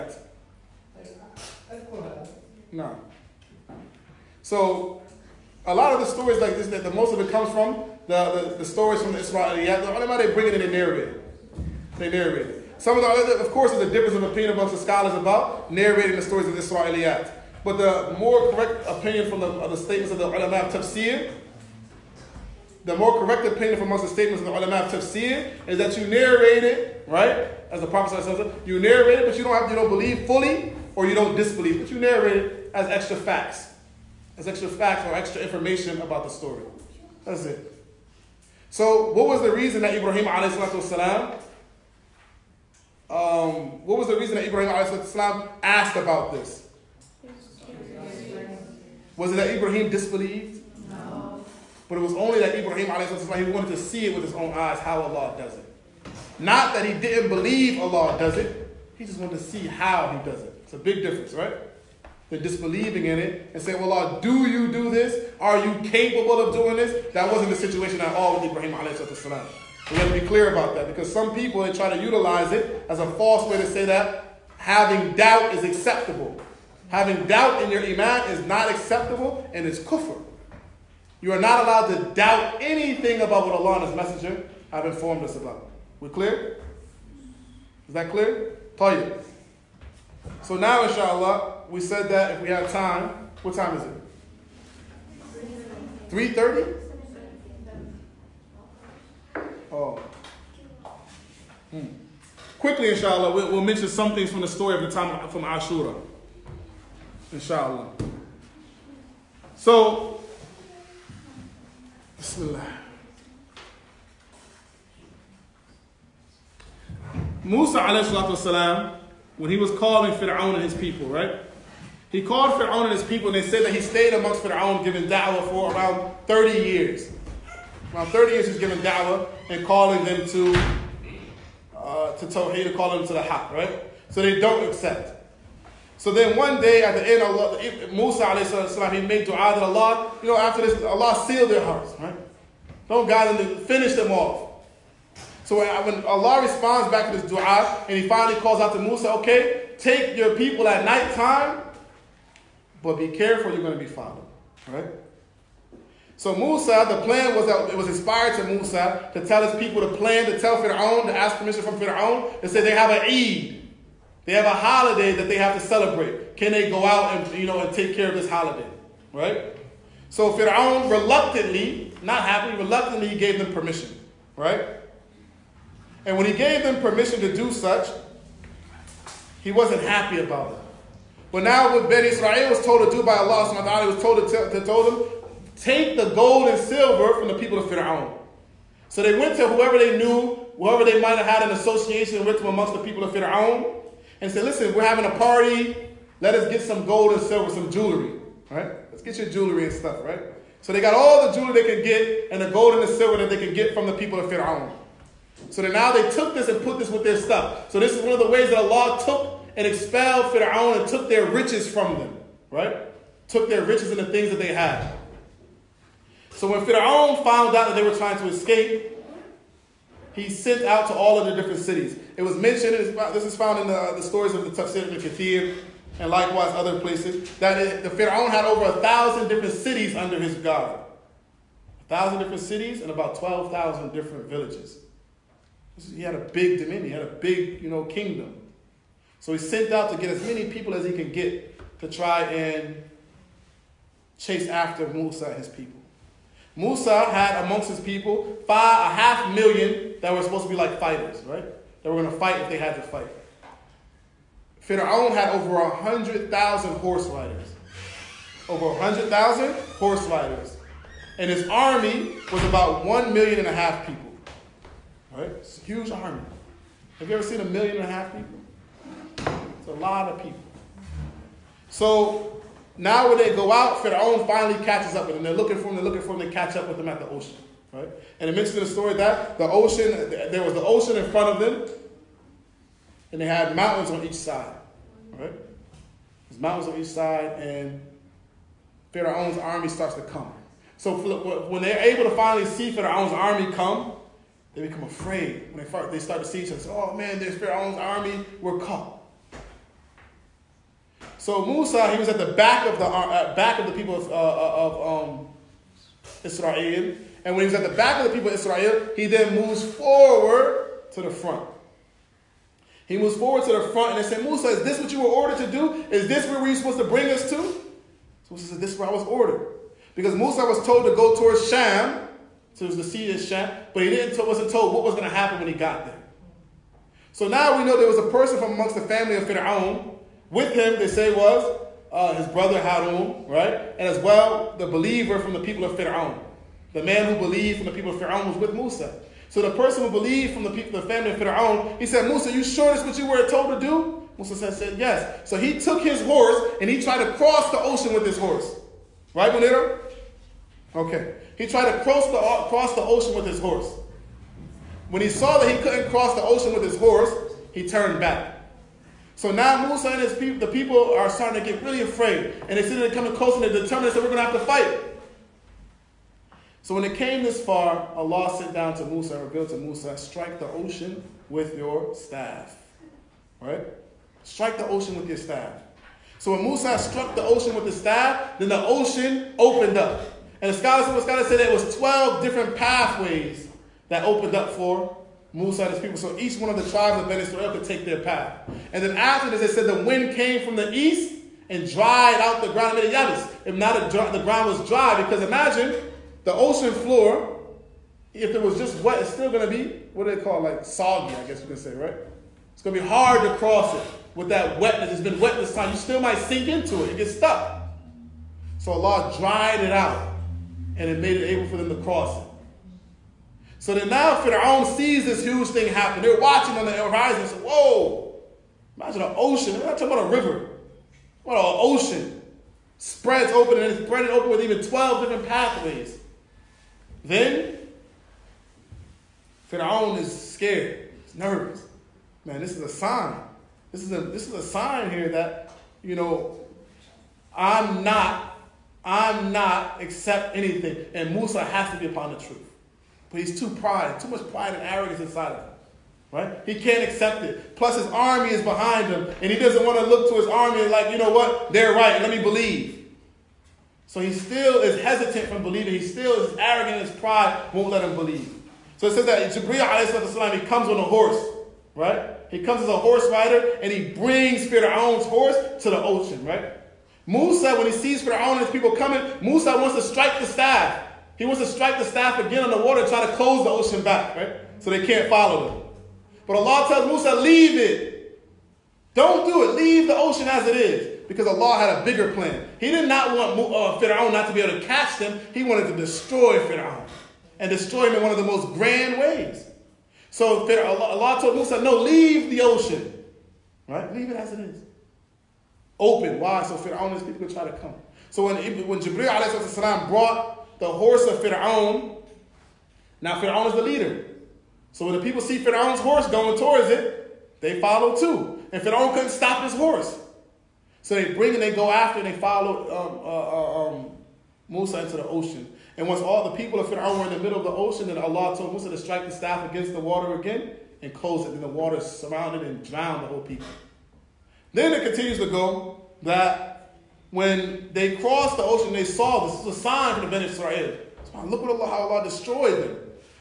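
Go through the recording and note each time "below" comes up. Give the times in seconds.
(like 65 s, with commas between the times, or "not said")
not said.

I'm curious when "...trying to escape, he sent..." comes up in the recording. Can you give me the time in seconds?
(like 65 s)
217 s.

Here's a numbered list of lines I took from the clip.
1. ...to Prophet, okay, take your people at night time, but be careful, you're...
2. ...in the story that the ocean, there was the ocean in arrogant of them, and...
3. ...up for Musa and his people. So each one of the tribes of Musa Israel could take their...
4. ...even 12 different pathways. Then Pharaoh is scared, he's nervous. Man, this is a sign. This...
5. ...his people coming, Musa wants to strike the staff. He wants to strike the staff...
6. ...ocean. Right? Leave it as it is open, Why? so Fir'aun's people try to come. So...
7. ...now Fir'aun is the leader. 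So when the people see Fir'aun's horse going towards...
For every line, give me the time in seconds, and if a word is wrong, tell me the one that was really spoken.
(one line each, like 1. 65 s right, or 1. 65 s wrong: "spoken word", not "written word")
1. 148 s wrong: "Musa", not "Prophet"
2. 278 s wrong: "front", not "arrogant"
3. 384 s wrong: "Bani", not "Musa"
4. 424 s right
5. 468 s right
6. 492 s right
7. 503 s right.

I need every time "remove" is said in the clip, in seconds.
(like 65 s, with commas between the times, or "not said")
not said.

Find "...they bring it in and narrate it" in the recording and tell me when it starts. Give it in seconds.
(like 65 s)
10 s.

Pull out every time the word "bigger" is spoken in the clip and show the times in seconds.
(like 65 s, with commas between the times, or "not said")
481 s.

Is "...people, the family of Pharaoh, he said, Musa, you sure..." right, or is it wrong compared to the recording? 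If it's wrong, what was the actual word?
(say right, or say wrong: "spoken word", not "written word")
right.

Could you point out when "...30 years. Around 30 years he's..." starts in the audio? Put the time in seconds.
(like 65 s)
126 s.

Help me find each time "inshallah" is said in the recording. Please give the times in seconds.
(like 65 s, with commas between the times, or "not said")
90 s, 102 s, 107 s.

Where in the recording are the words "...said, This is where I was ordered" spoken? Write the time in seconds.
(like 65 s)
318 s.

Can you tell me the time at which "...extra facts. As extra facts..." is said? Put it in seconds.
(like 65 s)
32 s.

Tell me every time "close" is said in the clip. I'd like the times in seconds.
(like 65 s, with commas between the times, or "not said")
363 s, 473 s, 520 s.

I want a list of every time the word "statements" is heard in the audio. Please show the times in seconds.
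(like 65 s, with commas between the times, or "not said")
19 s, 24 s.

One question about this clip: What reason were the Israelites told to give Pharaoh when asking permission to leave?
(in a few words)
An Eid.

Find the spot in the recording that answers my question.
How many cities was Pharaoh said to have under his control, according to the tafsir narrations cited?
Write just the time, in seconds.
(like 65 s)
228 s.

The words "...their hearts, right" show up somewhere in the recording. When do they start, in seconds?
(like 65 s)
141 s.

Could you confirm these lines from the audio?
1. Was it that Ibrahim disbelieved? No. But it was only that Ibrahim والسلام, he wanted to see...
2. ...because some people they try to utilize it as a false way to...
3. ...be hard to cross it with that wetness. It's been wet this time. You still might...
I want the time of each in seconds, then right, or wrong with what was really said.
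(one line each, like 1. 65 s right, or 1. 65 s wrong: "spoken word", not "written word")
1. 49 s right
2. 70 s right
3. 402 s right.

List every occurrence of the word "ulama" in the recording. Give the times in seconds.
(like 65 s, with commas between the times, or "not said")
9 s, 20 s, 24 s.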